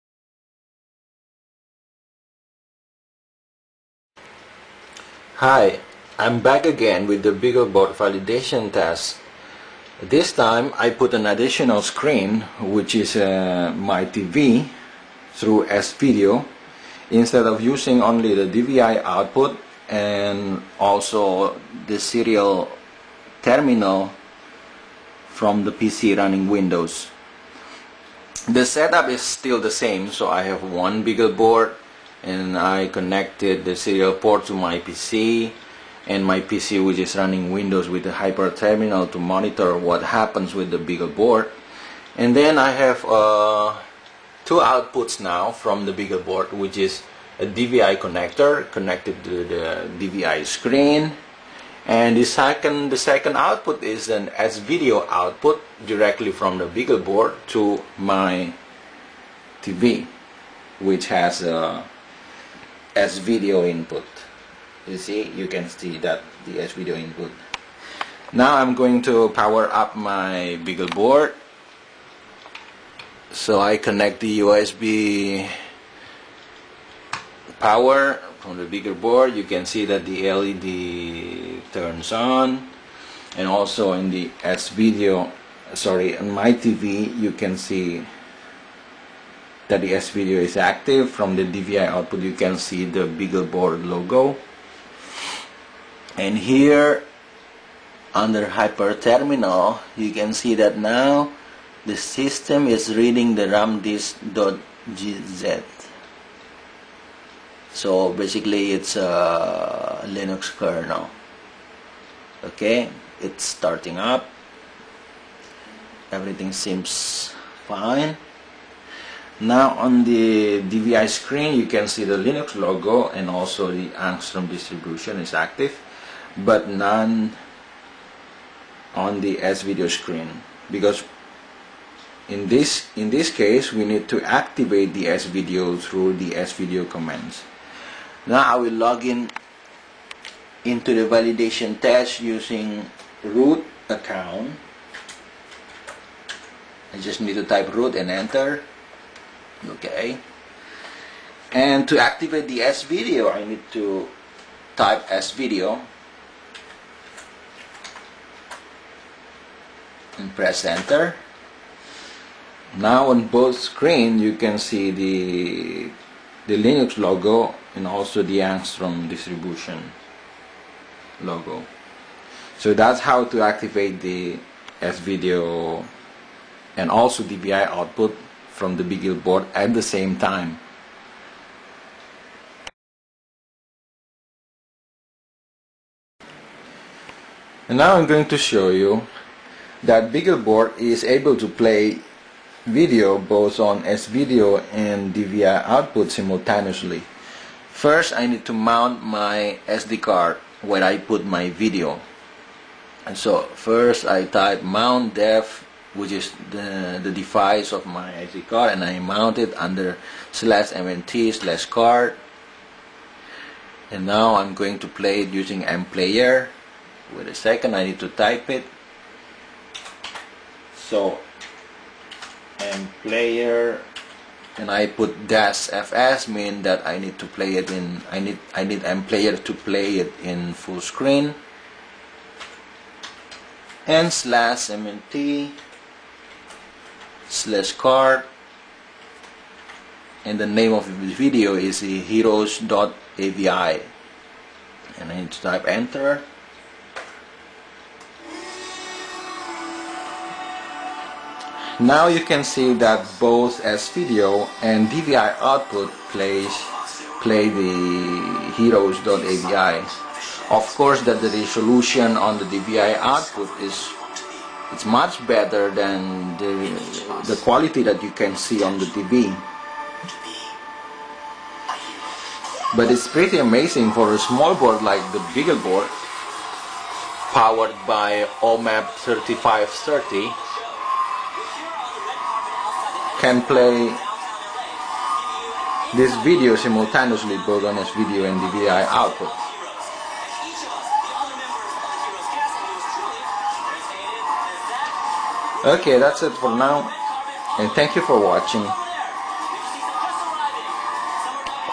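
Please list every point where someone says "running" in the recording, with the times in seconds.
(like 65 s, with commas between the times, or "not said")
26 s, 37 s.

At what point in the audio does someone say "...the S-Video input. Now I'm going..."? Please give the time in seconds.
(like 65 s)
66 s.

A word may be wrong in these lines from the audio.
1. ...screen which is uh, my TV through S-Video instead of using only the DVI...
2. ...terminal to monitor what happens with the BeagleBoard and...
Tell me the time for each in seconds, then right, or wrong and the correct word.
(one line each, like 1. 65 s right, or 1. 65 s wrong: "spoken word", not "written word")
1. 11 s right
2. 38 s right.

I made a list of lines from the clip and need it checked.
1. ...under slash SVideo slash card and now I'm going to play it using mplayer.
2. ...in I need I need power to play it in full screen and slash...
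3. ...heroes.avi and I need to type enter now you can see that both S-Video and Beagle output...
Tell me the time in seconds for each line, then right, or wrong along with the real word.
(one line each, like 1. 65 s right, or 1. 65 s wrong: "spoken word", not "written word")
1. 209 s wrong: "MNT", not "SVideo"
2. 227 s wrong: "mplayer", not "power"
3. 241 s wrong: "DVI", not "Beagle".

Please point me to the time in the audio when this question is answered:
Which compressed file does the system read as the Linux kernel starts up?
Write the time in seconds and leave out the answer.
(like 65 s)
103 s.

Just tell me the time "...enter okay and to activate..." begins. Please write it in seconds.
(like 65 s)
148 s.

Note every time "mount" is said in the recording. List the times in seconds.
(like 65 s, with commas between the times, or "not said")
198 s, 204 s, 208 s.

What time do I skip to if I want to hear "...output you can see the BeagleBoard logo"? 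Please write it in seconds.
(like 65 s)
91 s.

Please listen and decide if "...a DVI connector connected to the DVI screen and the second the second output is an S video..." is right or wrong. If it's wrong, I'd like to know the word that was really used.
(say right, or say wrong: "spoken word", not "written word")
right.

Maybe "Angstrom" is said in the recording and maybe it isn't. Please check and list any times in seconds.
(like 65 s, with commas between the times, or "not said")
123 s, 168 s.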